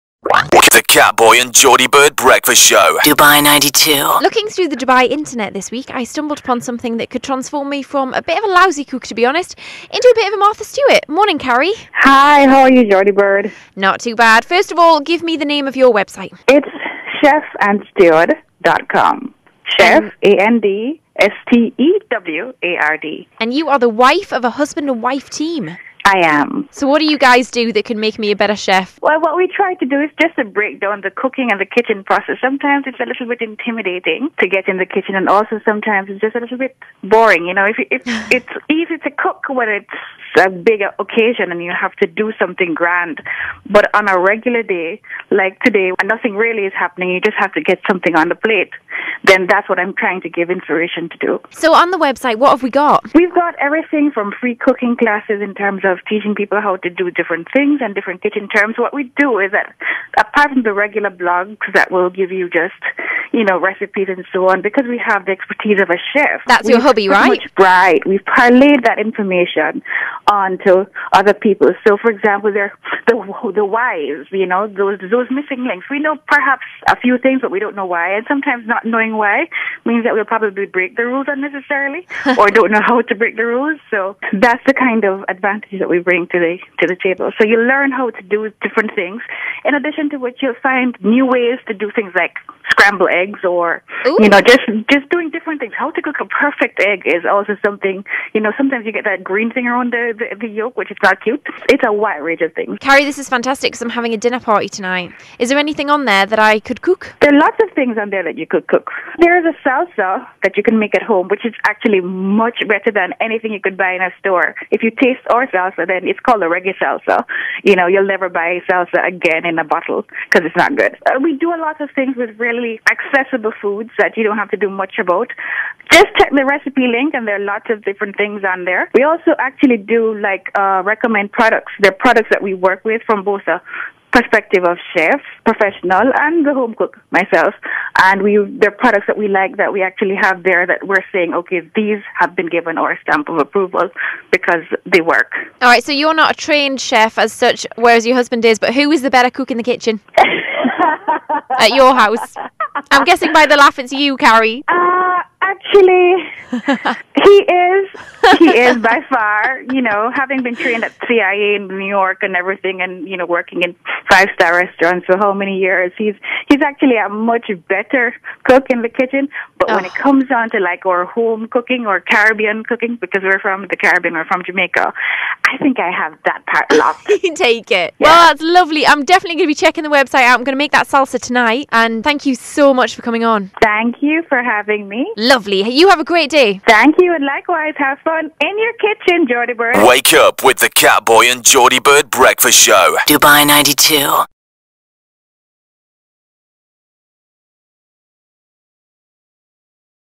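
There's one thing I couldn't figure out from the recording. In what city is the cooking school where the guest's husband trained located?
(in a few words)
New York.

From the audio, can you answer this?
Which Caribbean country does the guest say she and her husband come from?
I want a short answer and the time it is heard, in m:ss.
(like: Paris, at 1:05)
Jamaica, at 2:54.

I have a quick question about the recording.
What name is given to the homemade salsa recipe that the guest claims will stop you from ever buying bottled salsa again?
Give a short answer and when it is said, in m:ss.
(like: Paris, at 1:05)
reggae salsa, at 1:56.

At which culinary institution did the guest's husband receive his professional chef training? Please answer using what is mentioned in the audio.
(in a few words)
CIA.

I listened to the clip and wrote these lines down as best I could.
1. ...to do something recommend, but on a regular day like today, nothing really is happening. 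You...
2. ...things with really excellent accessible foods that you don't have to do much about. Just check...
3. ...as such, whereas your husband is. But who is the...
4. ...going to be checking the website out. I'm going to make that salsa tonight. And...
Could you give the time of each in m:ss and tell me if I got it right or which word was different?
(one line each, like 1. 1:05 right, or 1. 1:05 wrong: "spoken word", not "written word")
1. 0:41 wrong: "grand", not "recommend"
2. 2:01 right
3. 2:27 right
4. 2:59 right.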